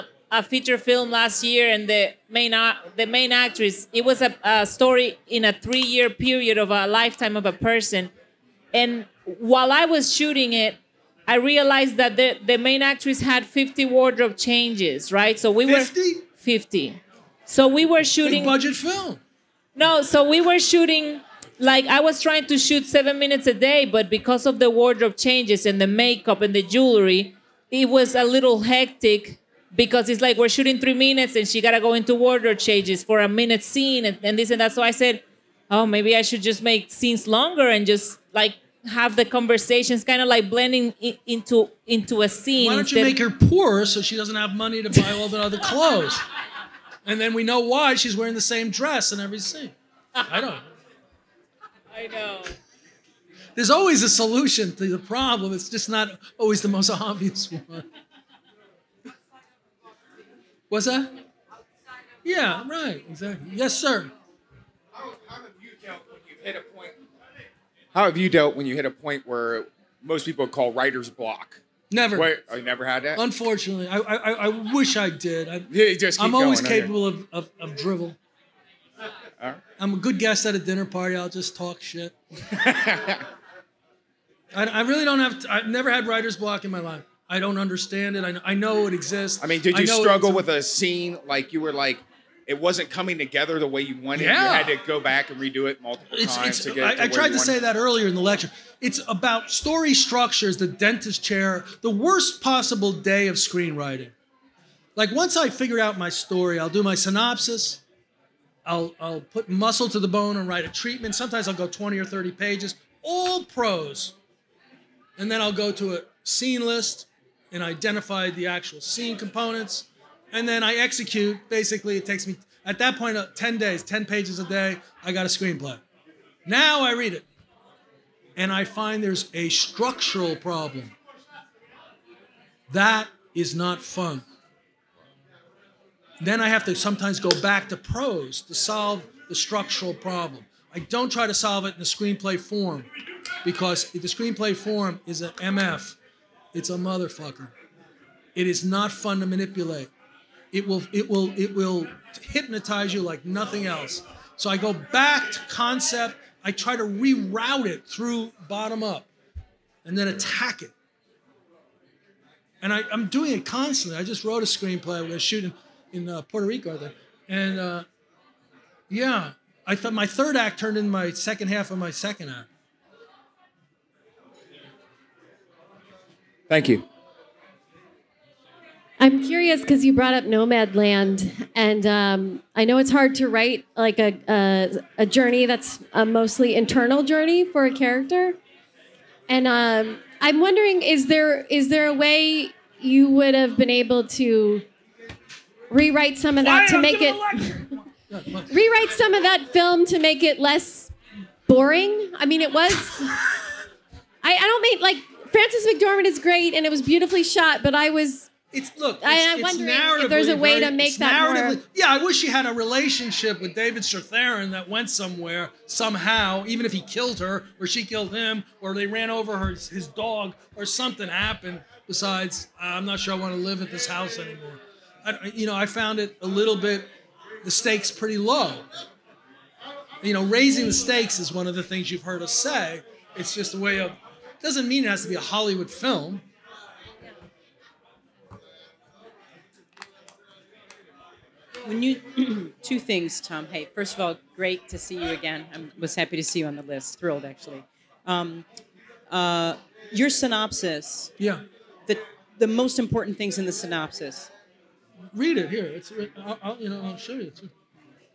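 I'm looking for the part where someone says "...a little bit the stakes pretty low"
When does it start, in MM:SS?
03:46.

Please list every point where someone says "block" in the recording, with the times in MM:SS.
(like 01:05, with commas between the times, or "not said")
01:11, 01:26.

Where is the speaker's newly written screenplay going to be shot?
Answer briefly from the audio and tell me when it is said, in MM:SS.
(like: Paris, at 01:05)
Puerto Rico, at 02:46.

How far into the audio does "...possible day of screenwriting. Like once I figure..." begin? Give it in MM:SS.
01:42.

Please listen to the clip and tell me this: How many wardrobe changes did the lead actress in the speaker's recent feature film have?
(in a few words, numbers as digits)
50.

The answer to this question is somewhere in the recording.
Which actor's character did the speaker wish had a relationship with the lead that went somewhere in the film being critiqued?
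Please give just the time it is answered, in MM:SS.
03:33.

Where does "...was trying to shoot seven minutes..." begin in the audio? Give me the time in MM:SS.
00:21.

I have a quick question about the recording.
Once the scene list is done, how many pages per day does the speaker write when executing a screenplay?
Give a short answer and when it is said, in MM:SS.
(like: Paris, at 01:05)
10, at 02:03.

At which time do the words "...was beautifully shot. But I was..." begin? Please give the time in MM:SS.
03:26.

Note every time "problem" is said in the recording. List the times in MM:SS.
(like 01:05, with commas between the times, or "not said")
00:54, 02:10, 02:19.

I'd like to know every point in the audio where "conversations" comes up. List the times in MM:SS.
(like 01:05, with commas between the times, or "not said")
00:39.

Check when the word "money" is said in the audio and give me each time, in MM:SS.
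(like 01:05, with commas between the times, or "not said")
00:44.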